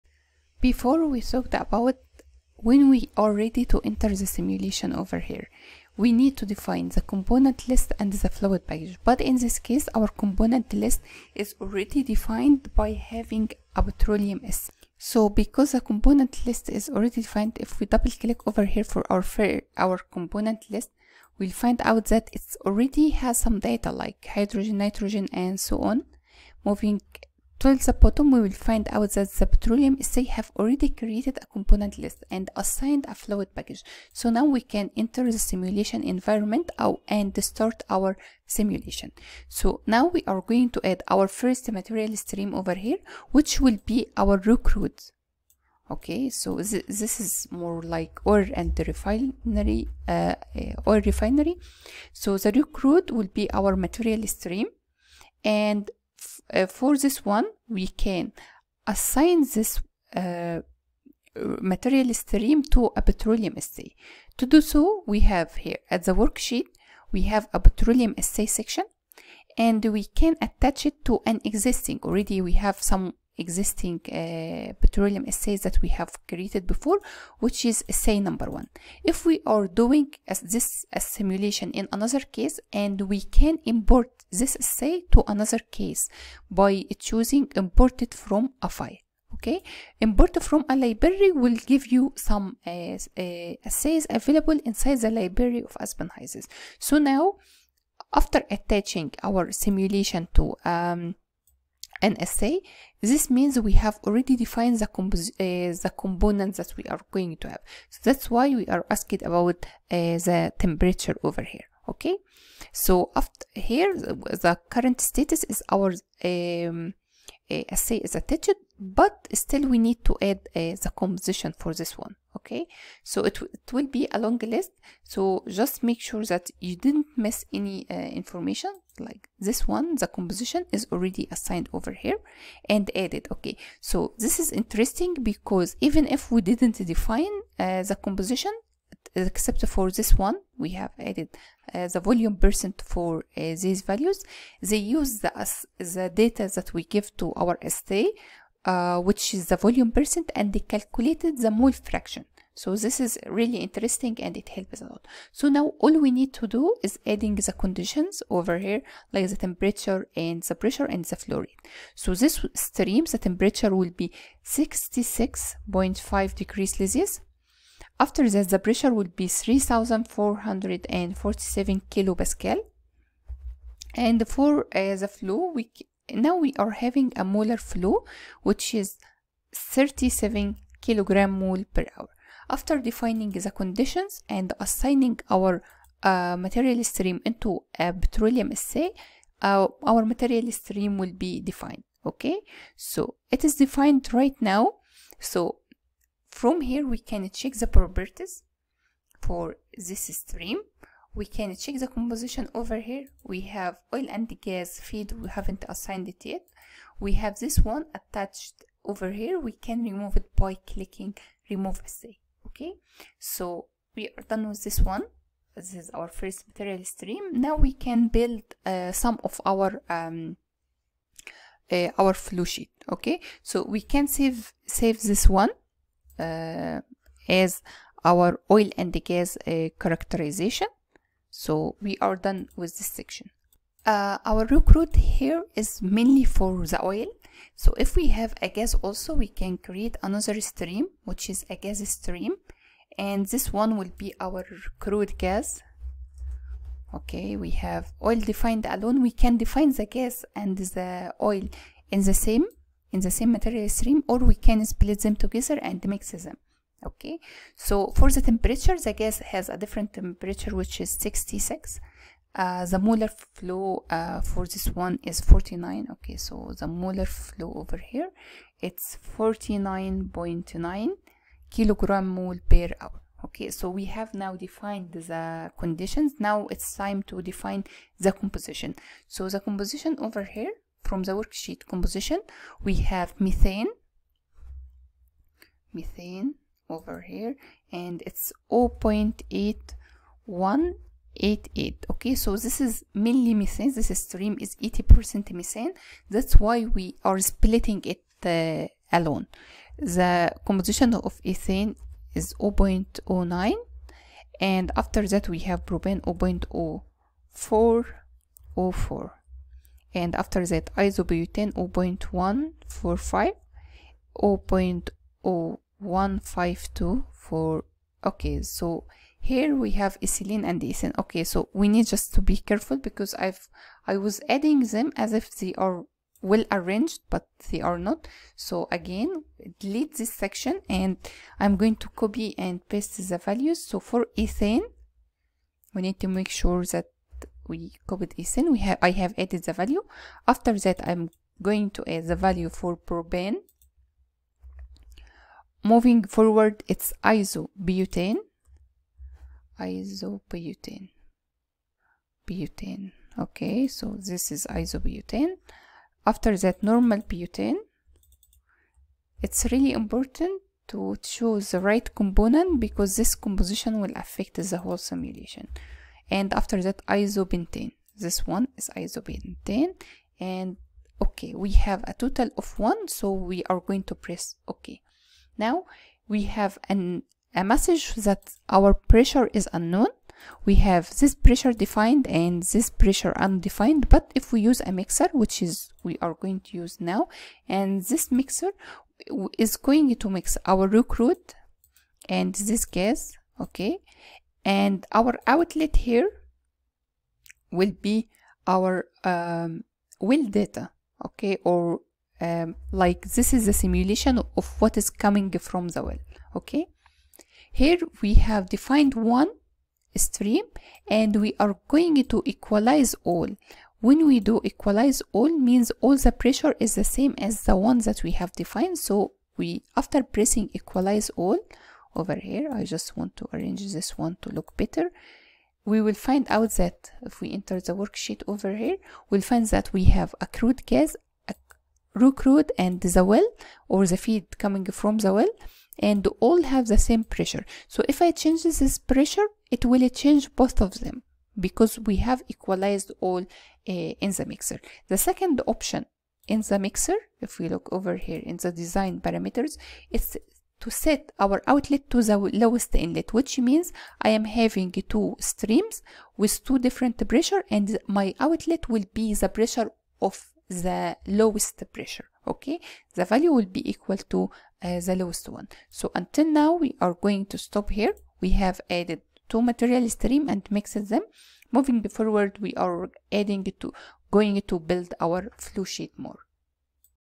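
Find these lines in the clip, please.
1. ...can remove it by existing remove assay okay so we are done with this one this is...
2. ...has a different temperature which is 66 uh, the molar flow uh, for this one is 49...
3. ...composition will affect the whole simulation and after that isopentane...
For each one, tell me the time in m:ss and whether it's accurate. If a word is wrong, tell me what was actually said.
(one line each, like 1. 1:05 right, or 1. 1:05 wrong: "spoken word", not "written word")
1. 3:29 wrong: "clicking", not "existing"
2. 4:19 right
3. 6:03 right.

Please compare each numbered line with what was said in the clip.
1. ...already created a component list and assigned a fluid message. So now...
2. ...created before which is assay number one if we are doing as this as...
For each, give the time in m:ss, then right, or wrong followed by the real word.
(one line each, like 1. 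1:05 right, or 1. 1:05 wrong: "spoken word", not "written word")
1. 0:30 wrong: "package", not "message"
2. 1:16 right.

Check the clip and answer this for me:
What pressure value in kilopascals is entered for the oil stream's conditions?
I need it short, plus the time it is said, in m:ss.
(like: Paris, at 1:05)
3447, at 2:49.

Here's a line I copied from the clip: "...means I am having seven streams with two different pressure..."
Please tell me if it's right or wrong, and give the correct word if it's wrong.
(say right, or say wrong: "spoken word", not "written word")
wrong: "two", not "seven".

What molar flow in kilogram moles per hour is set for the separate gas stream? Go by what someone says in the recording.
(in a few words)
49.9.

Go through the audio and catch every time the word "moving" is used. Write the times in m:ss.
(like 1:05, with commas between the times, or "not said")
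0:26, 5:45, 7:51.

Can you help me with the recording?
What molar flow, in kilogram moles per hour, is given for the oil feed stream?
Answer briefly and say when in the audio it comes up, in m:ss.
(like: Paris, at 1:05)
37, at 2:59.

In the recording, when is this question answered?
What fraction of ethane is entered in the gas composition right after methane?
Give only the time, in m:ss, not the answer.
5:02.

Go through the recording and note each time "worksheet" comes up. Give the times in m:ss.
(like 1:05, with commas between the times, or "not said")
1:06, 4:41, 7:07.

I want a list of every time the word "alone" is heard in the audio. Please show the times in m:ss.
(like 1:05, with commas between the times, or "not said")
4:08, 4:58.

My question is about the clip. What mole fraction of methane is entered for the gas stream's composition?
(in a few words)
0.8188.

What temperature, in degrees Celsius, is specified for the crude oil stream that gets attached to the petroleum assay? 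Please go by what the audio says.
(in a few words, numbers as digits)
66.5.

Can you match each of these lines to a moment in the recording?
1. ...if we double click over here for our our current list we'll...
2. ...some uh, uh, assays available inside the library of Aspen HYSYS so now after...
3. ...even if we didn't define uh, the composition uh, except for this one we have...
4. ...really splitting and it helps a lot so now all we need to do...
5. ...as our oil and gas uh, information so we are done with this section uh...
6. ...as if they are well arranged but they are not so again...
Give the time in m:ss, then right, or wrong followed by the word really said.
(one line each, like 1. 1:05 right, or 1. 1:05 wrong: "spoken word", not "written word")
1. 0:17 wrong: "component", not "current"
2. 1:32 right
3. 2:15 right
4. 2:33 wrong: "interesting", not "splitting"
5. 3:47 wrong: "characterization", not "information"
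6. 5:24 right.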